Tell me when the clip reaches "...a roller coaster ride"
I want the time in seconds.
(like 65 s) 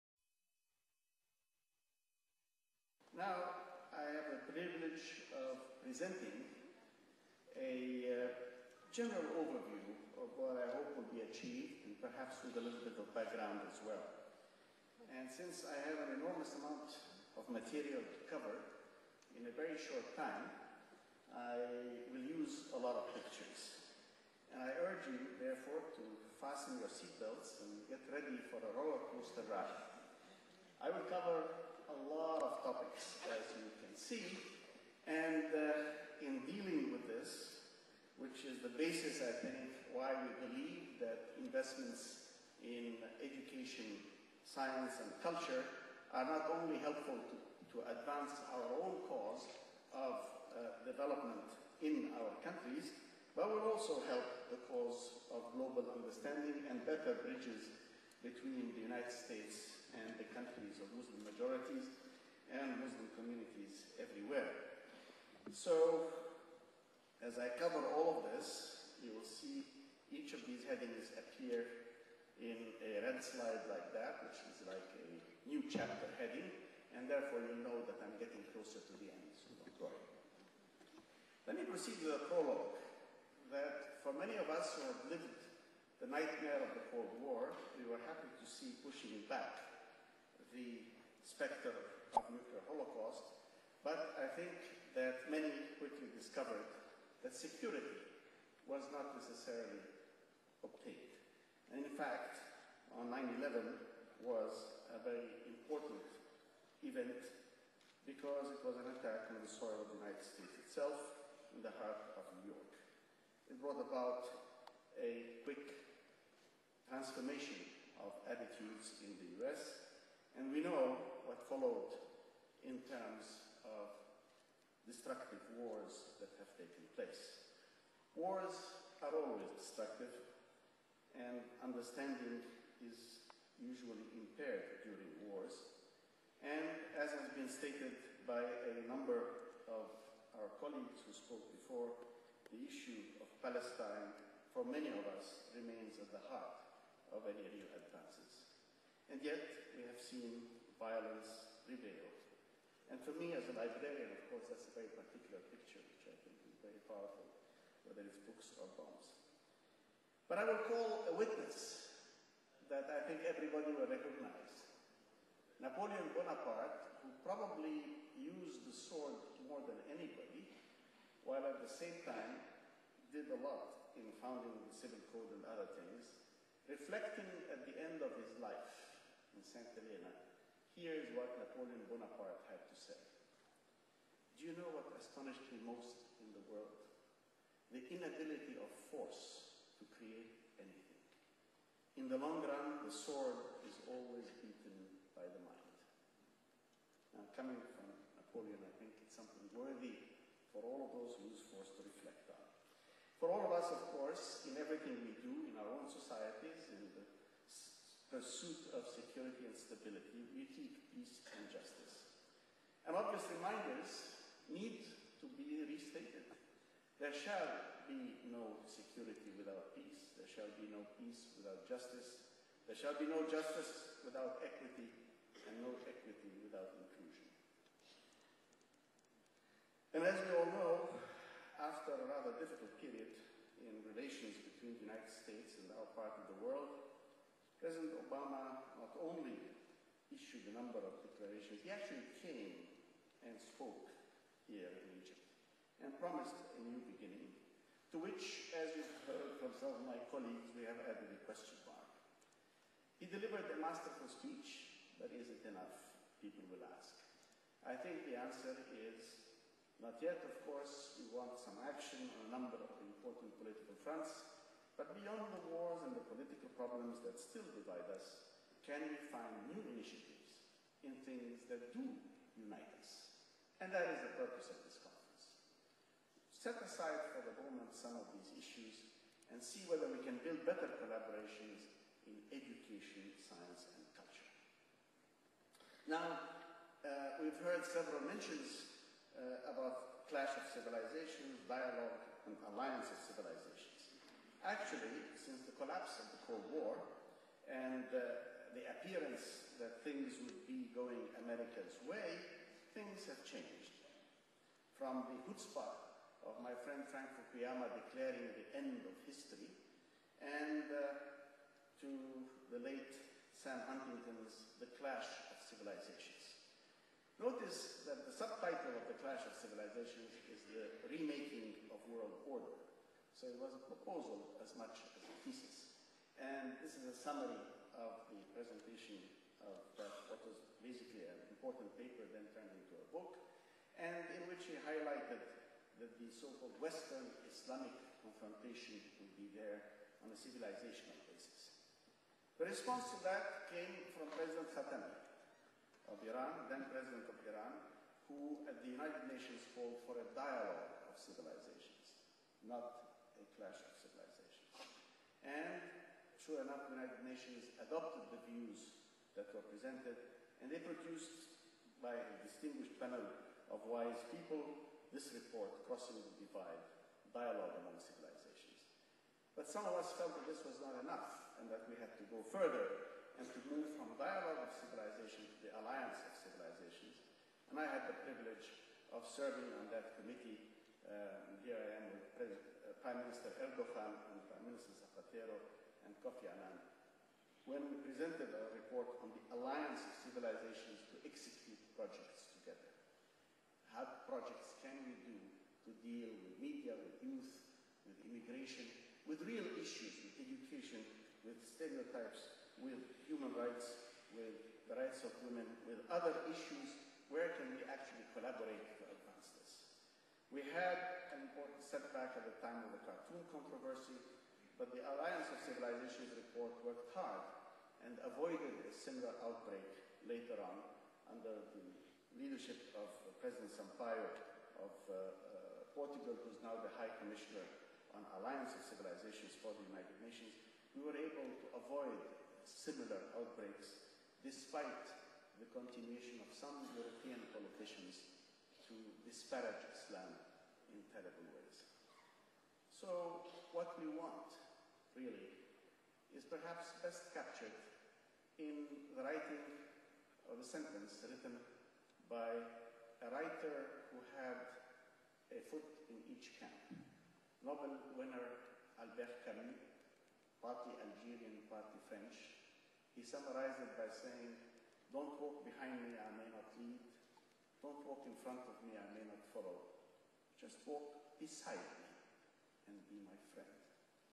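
28 s.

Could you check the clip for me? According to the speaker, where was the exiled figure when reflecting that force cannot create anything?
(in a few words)
St. Helena.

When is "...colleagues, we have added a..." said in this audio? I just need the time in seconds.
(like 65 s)
250 s.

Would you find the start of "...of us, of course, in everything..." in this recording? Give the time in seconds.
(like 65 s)
203 s.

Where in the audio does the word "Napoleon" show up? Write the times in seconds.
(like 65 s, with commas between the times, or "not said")
165 s, 181 s, 198 s.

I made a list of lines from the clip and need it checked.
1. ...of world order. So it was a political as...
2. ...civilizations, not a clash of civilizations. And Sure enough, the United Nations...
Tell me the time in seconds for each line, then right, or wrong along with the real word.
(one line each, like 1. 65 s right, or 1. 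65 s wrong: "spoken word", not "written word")
1. 321 s wrong: "proposal", not "political"
2. 350 s right.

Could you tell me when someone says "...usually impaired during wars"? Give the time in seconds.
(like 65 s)
133 s.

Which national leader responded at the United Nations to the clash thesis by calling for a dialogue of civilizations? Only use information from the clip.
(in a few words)
President Khatami.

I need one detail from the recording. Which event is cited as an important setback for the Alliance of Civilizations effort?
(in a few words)
The cartoon controversy.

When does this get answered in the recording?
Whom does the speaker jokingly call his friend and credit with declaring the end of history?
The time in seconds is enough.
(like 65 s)
306 s.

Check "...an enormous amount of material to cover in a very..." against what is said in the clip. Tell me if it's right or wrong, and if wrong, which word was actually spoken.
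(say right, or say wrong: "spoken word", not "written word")
right.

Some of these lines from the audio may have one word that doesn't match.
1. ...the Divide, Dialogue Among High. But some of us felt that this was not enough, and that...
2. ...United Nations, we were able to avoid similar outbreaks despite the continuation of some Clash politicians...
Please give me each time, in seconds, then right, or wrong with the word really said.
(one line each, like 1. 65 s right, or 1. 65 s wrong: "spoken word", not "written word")
1. 365 s wrong: "Civilizations", not "High"
2. 429 s wrong: "European", not "Clash".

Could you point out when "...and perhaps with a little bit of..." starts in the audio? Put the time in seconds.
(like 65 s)
11 s.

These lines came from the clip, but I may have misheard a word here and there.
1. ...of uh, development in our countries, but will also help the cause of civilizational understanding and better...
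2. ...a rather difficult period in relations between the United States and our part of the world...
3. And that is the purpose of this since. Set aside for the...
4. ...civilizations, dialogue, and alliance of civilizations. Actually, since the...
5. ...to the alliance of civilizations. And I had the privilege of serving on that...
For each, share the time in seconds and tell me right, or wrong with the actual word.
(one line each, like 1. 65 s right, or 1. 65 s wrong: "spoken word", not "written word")
1. 49 s wrong: "global", not "civilizational"
2. 231 s right
3. 273 s wrong: "conference", not "since"
4. 290 s right
5. 375 s right.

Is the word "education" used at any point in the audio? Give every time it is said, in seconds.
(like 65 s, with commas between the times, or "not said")
43 s, 282 s, 400 s.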